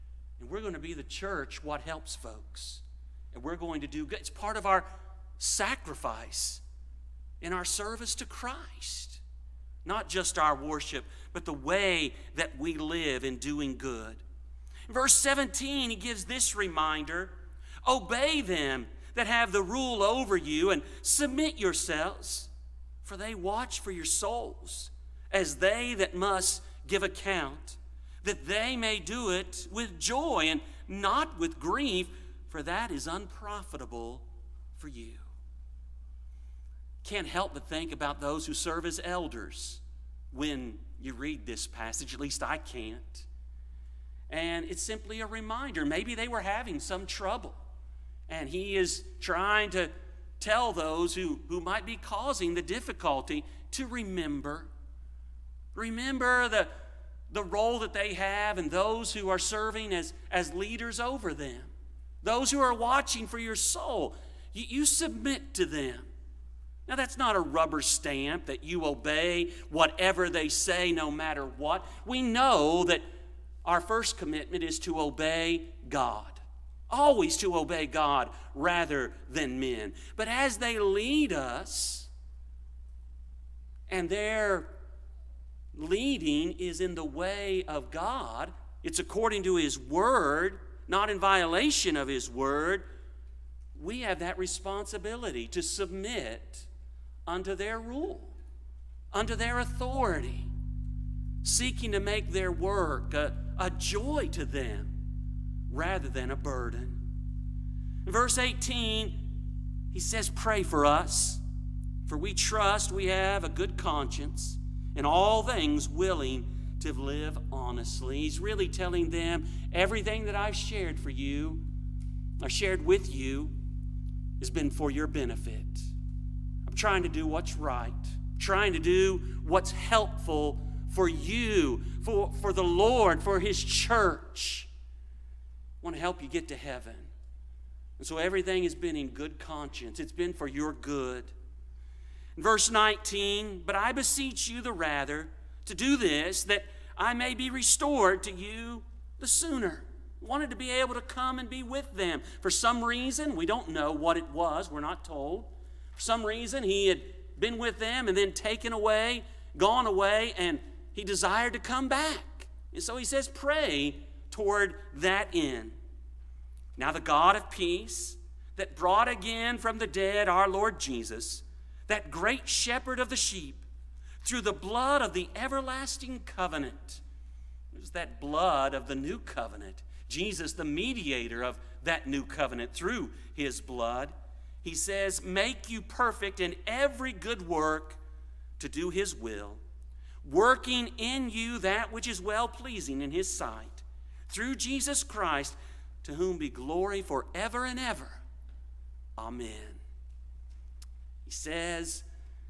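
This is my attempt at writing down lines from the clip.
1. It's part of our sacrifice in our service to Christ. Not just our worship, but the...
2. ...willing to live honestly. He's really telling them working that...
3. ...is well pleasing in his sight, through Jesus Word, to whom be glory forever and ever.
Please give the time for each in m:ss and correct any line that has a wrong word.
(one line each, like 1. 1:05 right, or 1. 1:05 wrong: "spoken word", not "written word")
1. 0:04 right
2. 1:55 wrong: "everything", not "working"
3. 3:12 wrong: "Christ", not "Word".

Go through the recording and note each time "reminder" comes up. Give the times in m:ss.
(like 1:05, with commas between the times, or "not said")
0:16, 0:45.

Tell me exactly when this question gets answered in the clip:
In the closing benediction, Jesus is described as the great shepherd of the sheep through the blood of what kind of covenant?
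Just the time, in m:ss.
2:55.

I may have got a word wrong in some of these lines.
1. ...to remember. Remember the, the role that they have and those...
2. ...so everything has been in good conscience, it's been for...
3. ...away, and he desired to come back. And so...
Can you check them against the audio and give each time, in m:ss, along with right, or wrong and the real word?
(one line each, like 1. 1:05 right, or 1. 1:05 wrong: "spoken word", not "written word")
1. 0:53 right
2. 2:18 right
3. 2:39 right.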